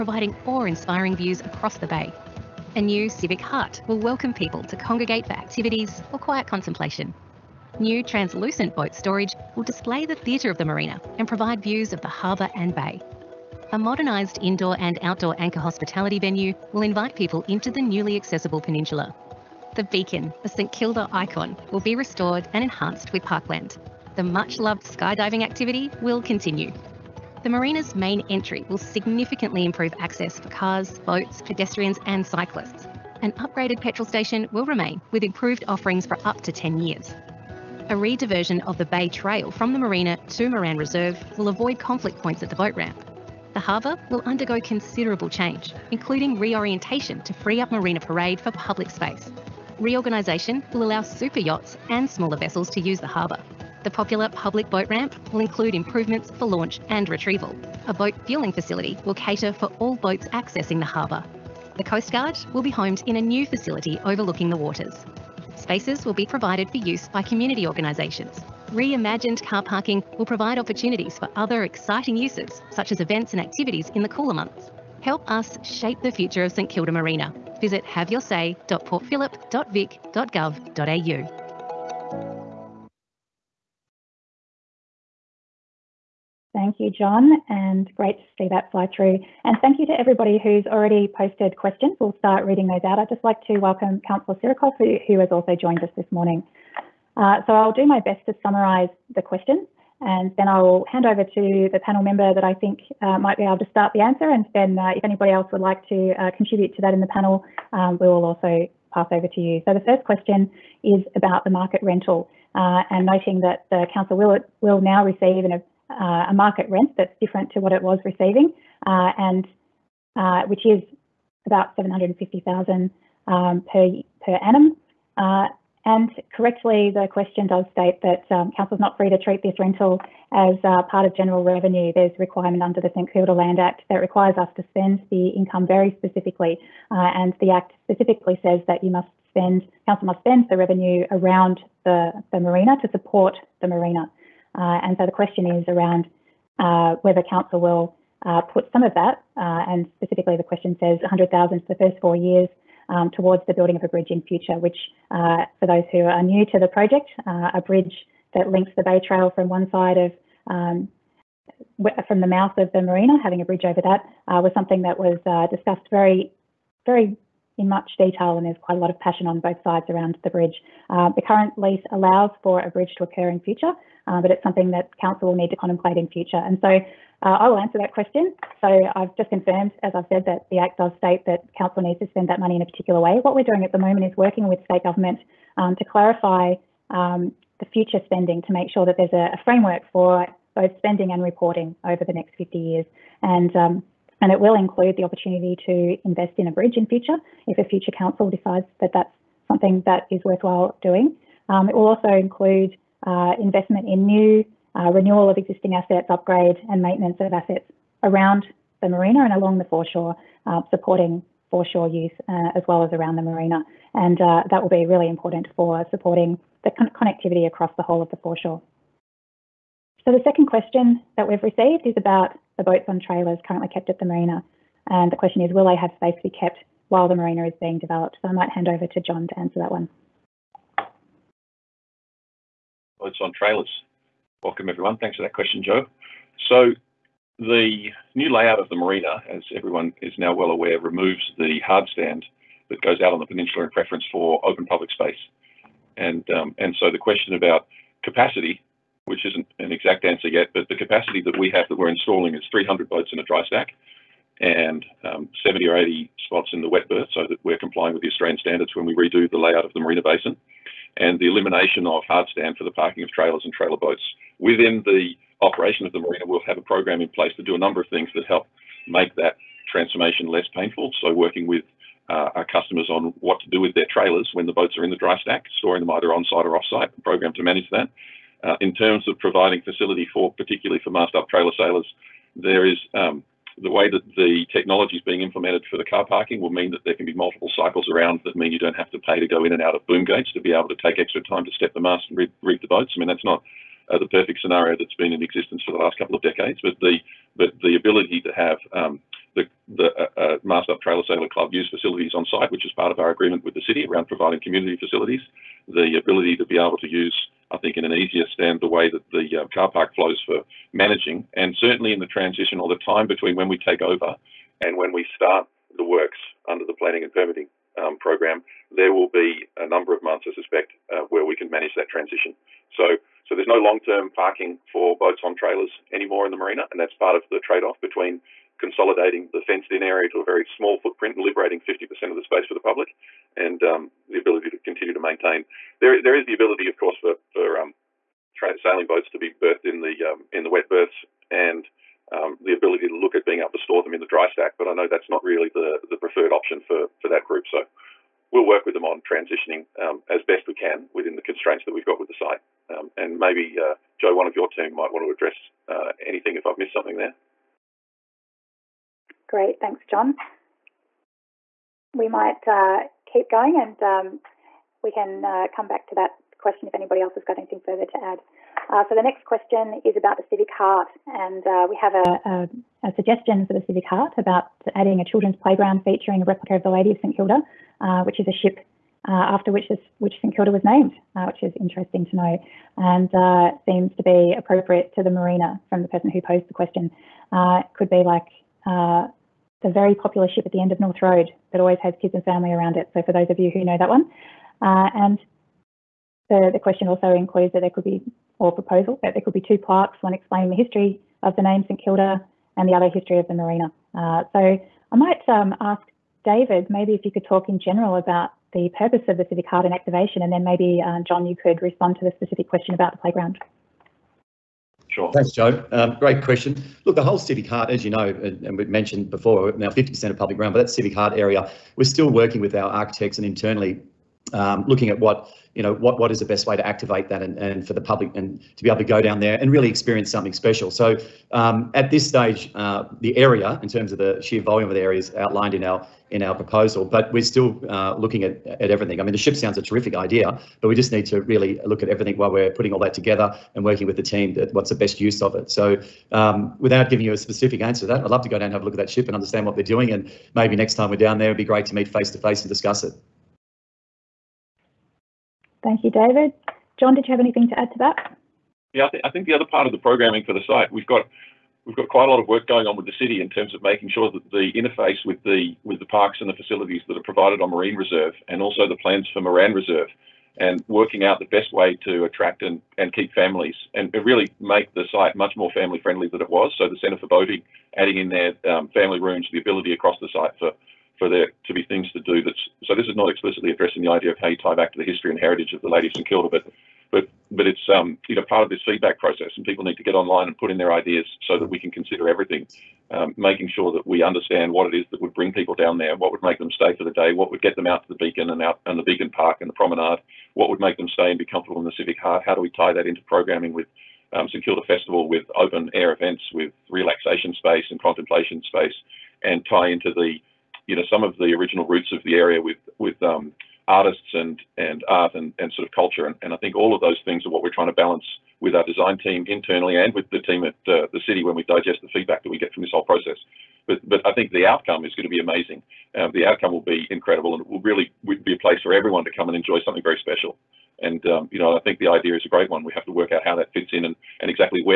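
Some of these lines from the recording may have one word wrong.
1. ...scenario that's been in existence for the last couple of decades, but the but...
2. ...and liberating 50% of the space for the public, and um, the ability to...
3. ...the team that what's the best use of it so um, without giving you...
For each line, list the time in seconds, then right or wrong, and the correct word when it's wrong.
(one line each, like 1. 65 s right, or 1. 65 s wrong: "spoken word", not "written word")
1. 294 s right
2. 331 s right
3. 443 s right.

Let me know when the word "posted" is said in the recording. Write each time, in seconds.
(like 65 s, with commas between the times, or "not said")
91 s.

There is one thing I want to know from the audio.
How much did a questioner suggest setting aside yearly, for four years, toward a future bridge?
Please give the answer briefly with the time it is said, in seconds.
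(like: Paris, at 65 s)
100,000, at 151 s.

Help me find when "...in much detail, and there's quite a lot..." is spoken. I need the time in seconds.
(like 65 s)
167 s.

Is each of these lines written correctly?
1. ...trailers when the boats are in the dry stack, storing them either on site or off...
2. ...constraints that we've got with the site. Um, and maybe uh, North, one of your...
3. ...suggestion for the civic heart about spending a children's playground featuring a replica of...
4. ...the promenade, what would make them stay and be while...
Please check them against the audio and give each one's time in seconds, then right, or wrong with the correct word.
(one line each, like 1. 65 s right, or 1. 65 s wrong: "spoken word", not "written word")
1. 273 s right
2. 351 s wrong: "Joe", not "North"
3. 372 s wrong: "adding", not "spending"
4. 499 s wrong: "comfortable", not "while".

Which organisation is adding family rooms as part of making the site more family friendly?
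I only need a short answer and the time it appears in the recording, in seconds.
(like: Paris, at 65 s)
Centre for Boating, at 476 s.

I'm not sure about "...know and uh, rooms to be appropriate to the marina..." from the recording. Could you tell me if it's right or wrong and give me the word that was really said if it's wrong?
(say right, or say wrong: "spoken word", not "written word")
wrong: "seems", not "rooms".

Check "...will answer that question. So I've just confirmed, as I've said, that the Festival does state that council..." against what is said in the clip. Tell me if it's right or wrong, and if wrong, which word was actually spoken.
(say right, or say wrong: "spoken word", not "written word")
wrong: "Act", not "Festival".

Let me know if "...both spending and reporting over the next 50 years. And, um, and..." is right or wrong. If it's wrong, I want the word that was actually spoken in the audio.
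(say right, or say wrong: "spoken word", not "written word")
right.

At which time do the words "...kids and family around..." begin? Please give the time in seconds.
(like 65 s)
392 s.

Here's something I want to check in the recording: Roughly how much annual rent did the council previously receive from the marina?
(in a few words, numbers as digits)
750,000.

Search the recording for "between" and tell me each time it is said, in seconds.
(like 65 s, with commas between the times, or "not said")
313 s, 327 s.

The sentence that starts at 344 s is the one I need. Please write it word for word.
But I know that's not really the the preferred option for for that group.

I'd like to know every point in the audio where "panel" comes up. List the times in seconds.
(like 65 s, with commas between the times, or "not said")
101 s, 107 s.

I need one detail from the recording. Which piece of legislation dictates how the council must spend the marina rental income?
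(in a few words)
St Kilda Land Act.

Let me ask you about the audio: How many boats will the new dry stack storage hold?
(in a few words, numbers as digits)
300.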